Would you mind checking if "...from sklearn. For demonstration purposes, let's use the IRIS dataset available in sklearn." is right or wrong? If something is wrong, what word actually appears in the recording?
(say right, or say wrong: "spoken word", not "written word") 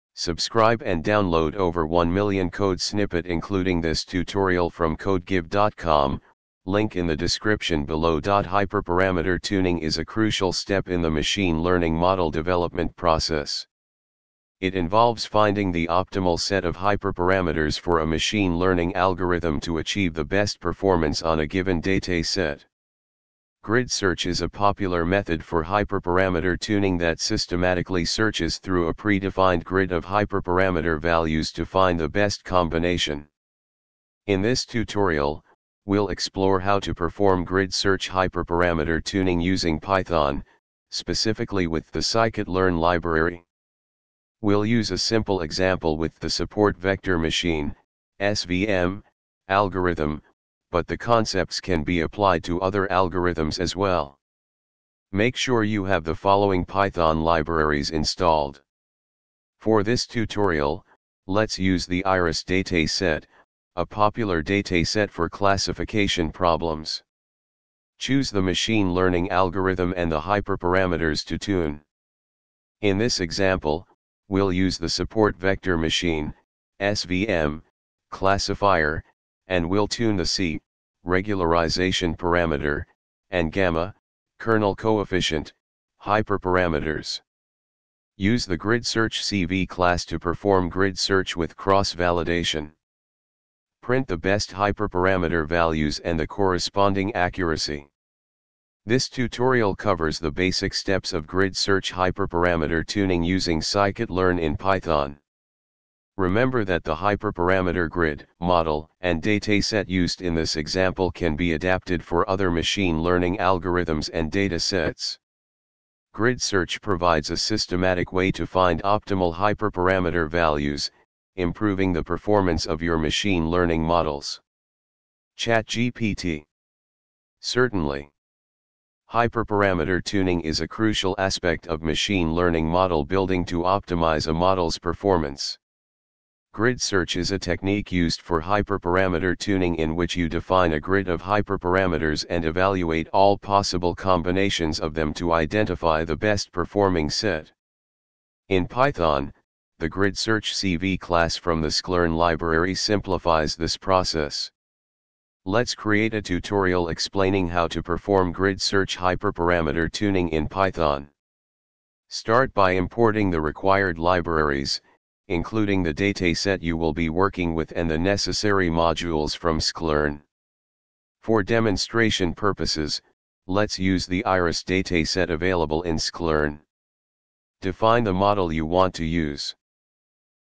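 right.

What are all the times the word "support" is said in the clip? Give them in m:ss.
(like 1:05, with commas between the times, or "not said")
0:46, 1:14.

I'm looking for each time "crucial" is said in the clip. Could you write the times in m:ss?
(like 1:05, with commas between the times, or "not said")
0:10, 2:10.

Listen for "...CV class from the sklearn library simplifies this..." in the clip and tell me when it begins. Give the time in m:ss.
2:30.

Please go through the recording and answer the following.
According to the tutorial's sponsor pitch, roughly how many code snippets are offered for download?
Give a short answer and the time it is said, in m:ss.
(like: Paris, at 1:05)
over 1 million, at 0:01.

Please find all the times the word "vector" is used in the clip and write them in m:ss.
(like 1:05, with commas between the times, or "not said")
0:46, 1:15.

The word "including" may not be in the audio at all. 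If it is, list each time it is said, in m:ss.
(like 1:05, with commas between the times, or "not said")
0:03, 2:45.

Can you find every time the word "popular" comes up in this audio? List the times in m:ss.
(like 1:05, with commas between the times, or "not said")
0:24, 1:03.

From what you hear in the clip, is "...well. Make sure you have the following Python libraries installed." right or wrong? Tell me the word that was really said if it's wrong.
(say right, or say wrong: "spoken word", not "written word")
right.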